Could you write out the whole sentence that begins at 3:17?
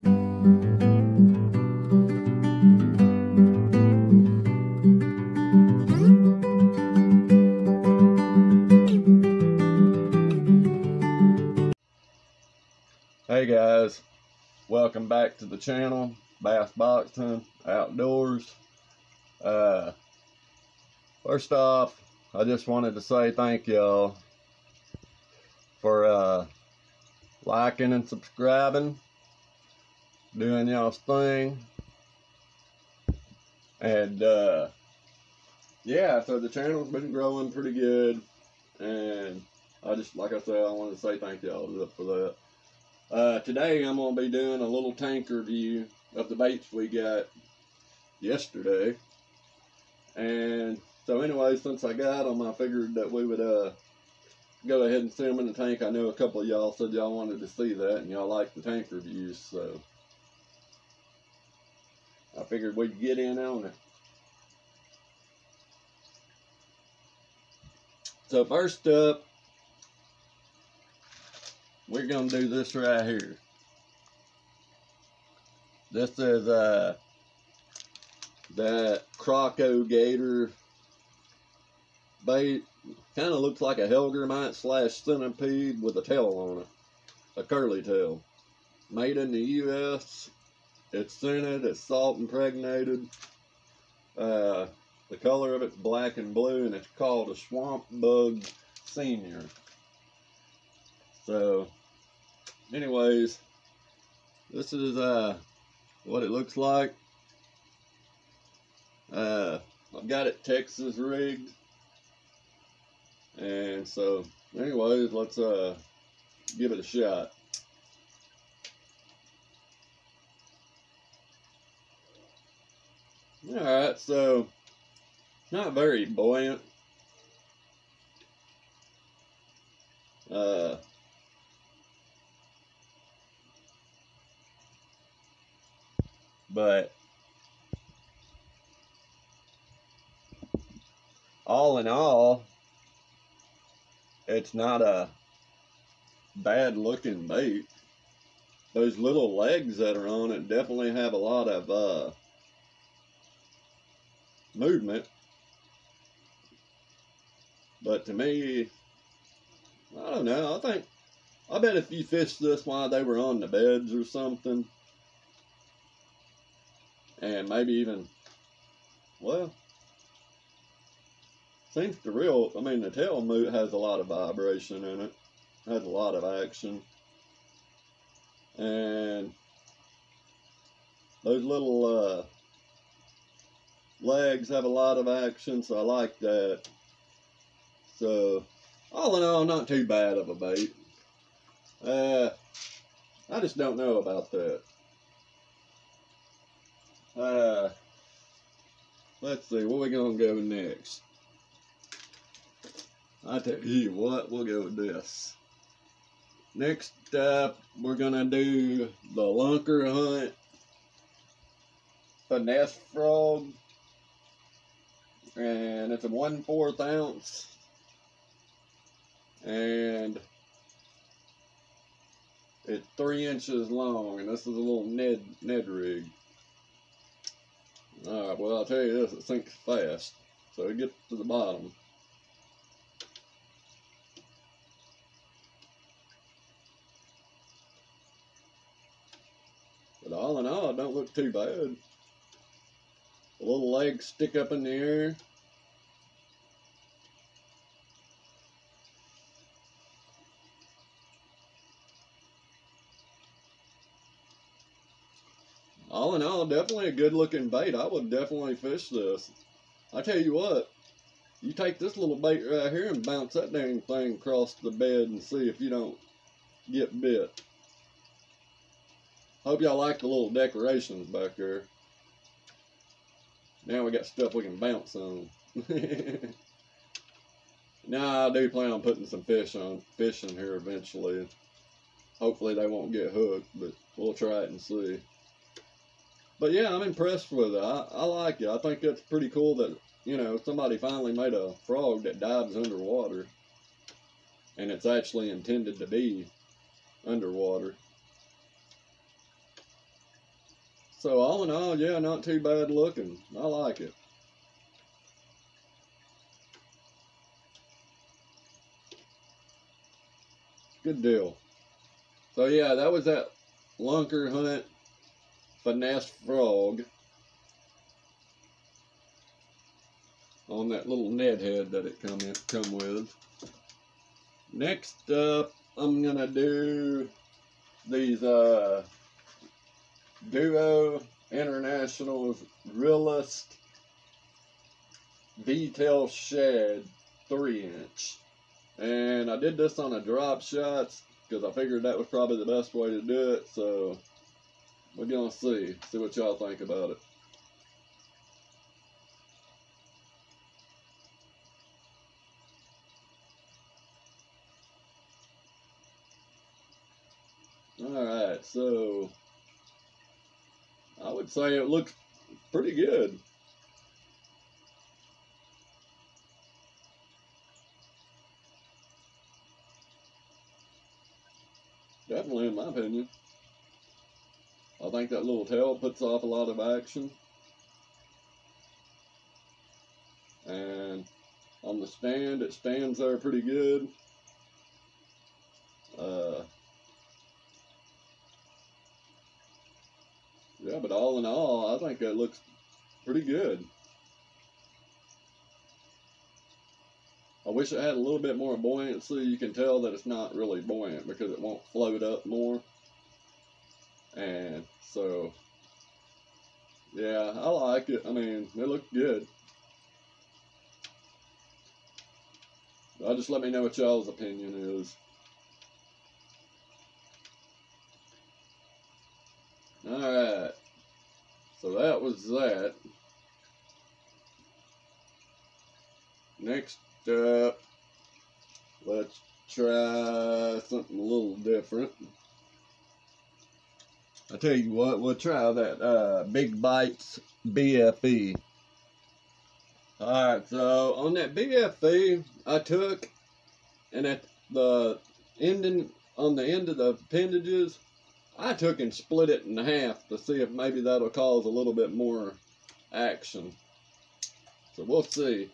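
Uh, let's see, where we gonna go next?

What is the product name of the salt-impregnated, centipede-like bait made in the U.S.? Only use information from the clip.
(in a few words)
Swamp Bug Senior.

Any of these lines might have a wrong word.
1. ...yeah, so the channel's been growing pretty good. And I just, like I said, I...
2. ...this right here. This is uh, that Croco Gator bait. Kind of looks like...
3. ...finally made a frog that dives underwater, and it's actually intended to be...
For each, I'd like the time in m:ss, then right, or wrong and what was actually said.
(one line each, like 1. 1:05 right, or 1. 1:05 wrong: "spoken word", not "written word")
1. 0:35 right
2. 1:12 right
3. 4:50 right.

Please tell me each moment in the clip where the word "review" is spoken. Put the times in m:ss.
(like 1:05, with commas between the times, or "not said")
0:45, 0:58.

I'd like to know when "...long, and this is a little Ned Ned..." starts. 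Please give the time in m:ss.
3:43.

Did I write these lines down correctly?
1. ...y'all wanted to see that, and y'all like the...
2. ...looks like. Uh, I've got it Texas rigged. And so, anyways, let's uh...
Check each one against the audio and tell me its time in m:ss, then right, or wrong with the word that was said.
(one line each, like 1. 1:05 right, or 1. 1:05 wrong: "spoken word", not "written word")
1. 0:56 right
2. 1:46 right.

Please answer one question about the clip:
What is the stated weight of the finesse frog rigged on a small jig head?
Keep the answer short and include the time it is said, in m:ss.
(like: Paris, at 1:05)
1/4 ounce, at 3:36.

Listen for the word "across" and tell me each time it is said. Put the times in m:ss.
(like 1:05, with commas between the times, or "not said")
4:24.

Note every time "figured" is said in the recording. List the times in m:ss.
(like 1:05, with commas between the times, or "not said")
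0:52, 1:02, 5:41.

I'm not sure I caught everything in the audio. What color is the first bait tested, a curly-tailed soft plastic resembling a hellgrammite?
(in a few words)
Black and blue.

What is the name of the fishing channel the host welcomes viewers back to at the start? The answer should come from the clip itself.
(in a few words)
Bassboxing Outdoors.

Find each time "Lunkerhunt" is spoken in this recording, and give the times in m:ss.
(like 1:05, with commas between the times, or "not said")
3:29, 5:13.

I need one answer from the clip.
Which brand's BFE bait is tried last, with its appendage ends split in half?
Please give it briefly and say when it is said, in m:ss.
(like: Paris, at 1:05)
Big Bites, at 7:16.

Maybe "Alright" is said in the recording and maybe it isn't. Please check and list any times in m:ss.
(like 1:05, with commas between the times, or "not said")
2:03, 5:57, 6:59, 7:19.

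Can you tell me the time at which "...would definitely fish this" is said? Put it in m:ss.
4:17.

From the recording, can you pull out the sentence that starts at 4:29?
Hope y'all like the little decorations back there.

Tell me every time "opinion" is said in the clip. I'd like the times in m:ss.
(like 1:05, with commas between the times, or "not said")
6:12, 6:54.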